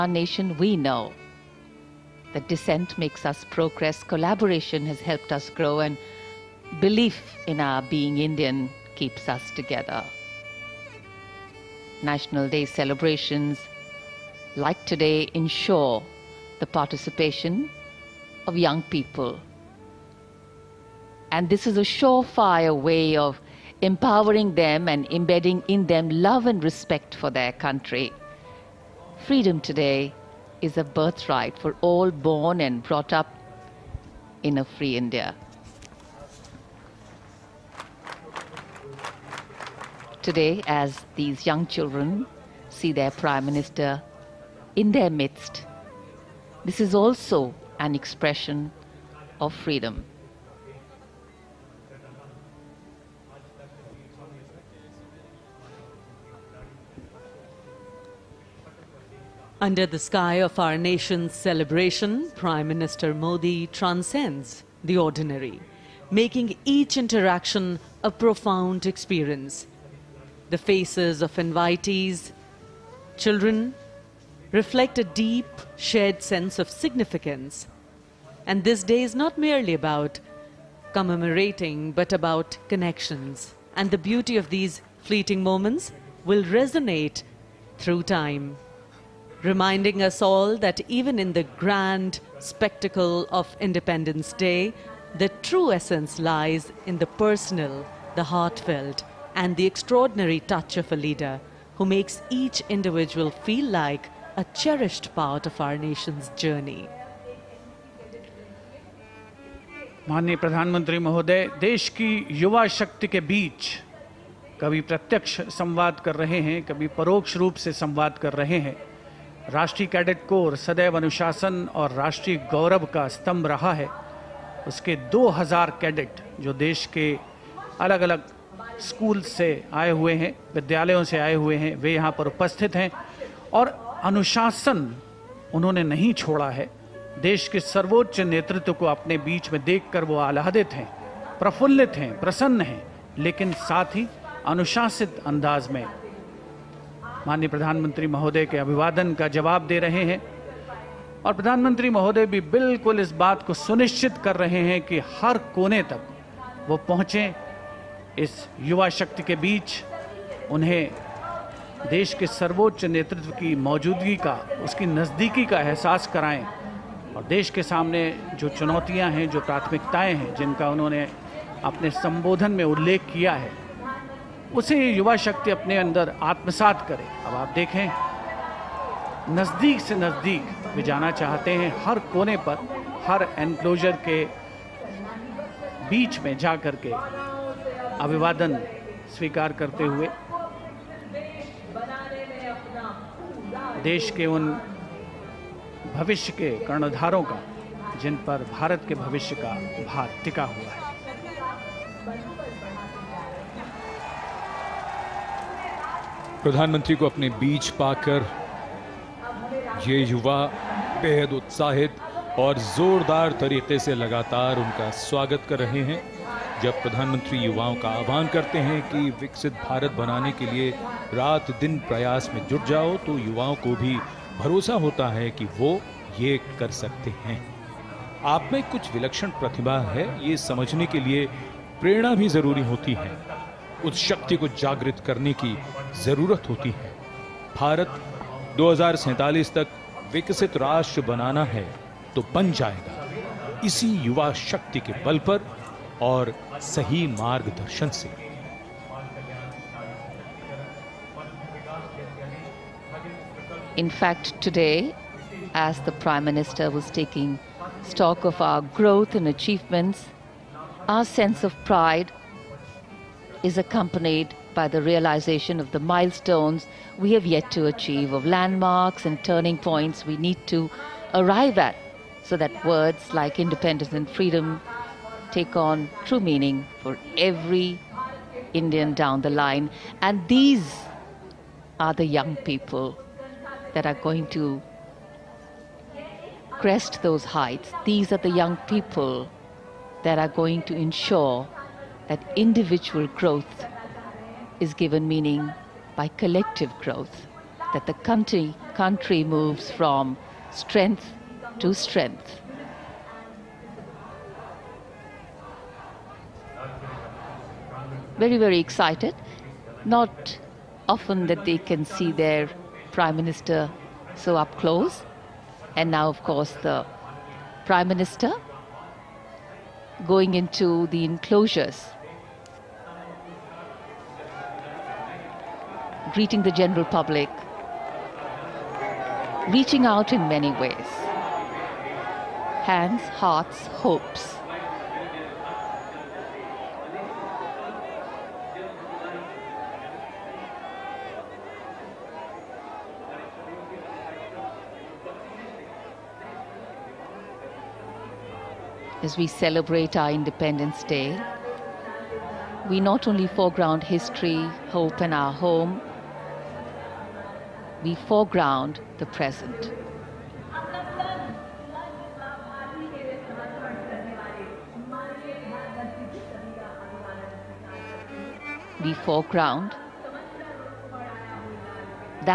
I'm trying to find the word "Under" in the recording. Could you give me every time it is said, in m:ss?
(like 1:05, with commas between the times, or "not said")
0:59.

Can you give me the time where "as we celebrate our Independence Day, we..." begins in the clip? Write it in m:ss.
5:49.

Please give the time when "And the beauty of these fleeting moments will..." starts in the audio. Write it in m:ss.
1:23.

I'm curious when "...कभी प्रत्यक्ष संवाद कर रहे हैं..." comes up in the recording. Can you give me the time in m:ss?
1:54.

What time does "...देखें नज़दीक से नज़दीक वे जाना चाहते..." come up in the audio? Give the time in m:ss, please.
2:57.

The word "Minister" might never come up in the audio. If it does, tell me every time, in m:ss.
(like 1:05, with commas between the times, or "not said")
0:43, 1:02, 4:16, 5:13, 5:17.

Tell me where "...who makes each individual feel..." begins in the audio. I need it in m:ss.
1:41.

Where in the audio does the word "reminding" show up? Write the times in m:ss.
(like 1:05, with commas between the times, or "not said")
1:29.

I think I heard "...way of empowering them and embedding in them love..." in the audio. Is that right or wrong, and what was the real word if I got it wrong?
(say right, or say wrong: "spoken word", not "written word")
right.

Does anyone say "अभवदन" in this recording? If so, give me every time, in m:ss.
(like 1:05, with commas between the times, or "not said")
2:28, 3:08.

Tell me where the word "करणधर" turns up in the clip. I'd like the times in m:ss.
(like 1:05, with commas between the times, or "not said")
3:16.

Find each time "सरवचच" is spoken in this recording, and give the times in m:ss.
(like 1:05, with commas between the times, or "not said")
2:17, 2:42.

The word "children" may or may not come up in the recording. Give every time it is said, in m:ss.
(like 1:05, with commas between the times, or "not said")
0:41, 1:13.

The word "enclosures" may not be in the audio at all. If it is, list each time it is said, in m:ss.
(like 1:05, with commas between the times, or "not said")
5:21.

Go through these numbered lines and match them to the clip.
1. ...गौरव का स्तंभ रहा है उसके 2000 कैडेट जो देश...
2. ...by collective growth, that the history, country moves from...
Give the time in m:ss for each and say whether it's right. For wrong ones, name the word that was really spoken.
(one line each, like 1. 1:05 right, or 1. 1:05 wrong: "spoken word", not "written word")
1. 2:02 right
2. 4:55 wrong: "country", not "history".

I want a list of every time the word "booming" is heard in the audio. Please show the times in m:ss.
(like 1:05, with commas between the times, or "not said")
not said.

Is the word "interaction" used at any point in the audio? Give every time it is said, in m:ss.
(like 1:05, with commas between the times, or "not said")
1:06.